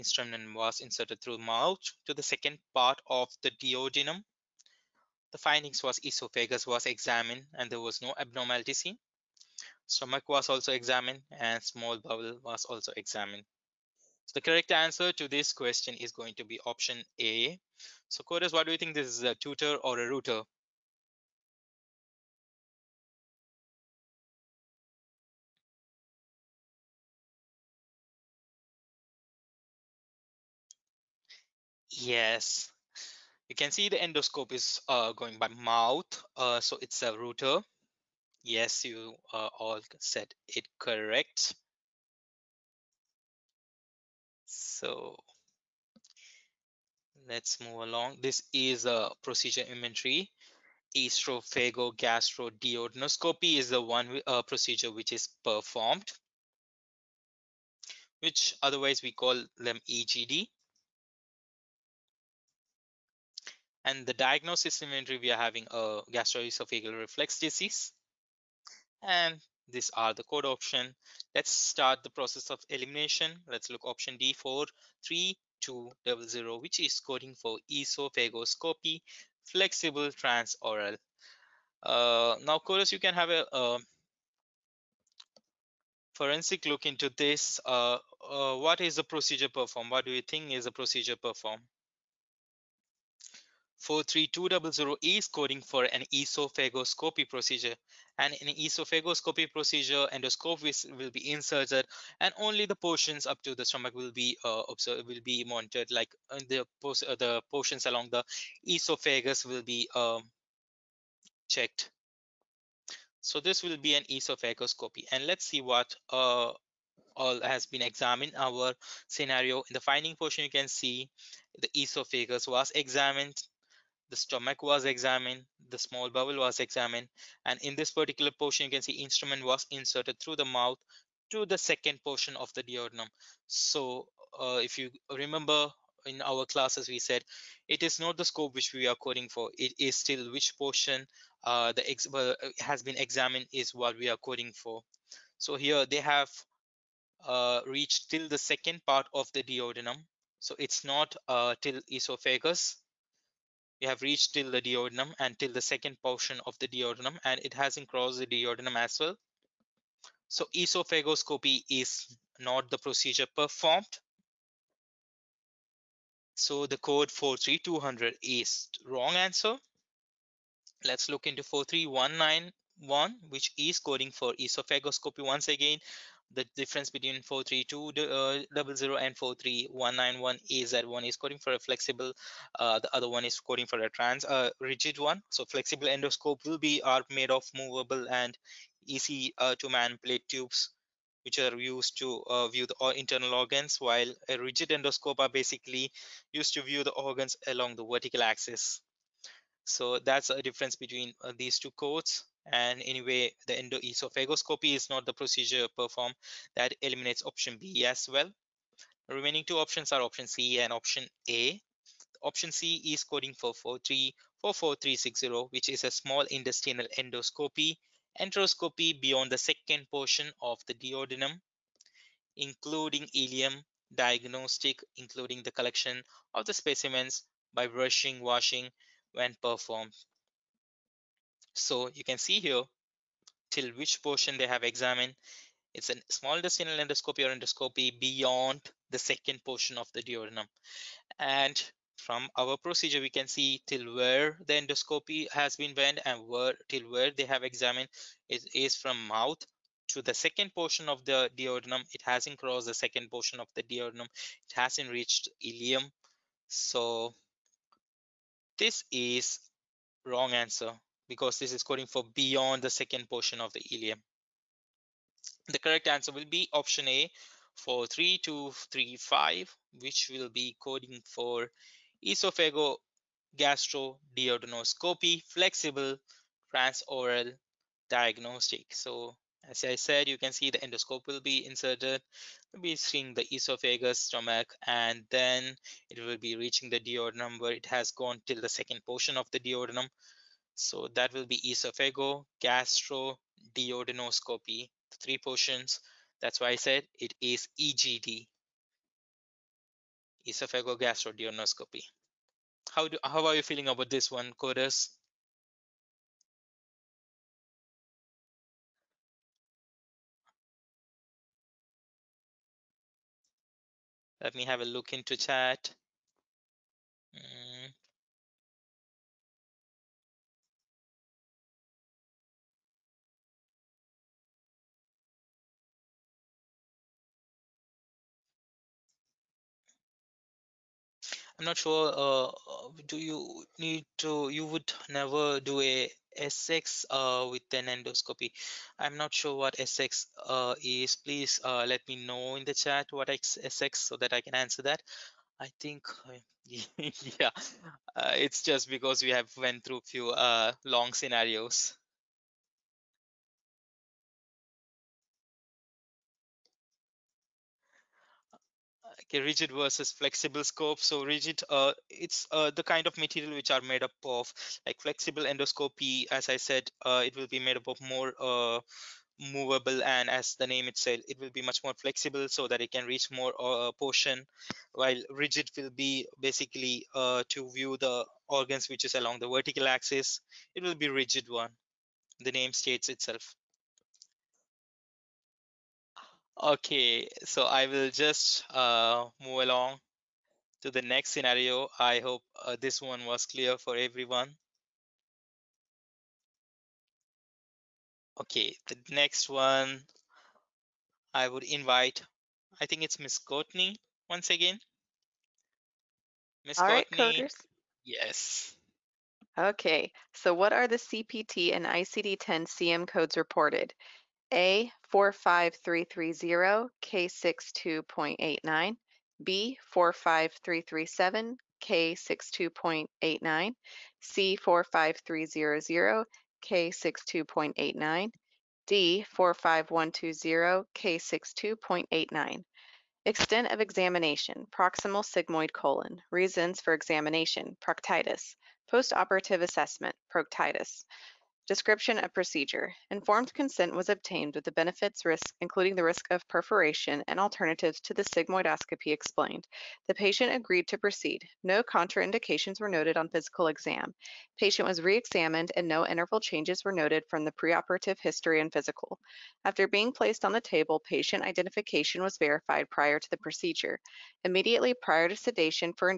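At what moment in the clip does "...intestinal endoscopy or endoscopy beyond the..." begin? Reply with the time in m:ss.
3:56.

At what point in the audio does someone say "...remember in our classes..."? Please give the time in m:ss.
2:15.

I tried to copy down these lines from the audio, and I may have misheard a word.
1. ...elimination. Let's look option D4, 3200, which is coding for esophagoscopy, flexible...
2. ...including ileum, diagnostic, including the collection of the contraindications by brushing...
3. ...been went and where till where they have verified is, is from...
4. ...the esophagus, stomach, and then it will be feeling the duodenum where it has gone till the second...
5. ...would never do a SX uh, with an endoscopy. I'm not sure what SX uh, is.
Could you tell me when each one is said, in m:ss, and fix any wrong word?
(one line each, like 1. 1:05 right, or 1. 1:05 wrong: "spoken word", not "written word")
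1. 1:12 right
2. 3:42 wrong: "specimens", not "contraindications"
3. 4:05 wrong: "examined", not "verified"
4. 4:43 wrong: "reaching", not "feeling"
5. 5:34 right.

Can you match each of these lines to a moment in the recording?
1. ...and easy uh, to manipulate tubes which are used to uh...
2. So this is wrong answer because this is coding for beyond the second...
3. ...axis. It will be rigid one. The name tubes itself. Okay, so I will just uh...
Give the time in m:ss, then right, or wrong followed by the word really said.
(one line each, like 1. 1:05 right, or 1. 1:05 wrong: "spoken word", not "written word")
1. 3:08 right
2. 4:16 right
3. 6:19 wrong: "states", not "tubes".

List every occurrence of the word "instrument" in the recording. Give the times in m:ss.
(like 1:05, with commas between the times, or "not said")
2:09.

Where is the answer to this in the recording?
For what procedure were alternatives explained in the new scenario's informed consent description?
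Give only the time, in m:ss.
7:28.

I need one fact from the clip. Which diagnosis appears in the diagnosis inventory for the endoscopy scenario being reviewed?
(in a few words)
Gastroesophageal reflux disease.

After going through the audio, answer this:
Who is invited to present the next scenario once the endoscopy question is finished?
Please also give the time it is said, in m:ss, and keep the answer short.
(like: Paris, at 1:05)
Miss Courtney, at 6:42.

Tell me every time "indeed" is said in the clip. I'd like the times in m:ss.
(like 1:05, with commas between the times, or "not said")
not said.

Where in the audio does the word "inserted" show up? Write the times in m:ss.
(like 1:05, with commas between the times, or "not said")
0:00, 1:41, 2:09, 4:41.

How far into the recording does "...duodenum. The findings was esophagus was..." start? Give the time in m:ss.
0:03.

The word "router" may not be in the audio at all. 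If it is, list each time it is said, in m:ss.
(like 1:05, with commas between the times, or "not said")
0:20, 0:37.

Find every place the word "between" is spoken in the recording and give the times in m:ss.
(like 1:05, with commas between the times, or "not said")
2:56, 3:20.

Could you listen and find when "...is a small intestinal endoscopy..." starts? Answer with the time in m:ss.
3:35.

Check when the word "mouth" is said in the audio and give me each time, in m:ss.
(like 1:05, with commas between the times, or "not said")
0:01, 0:35, 2:10, 4:09.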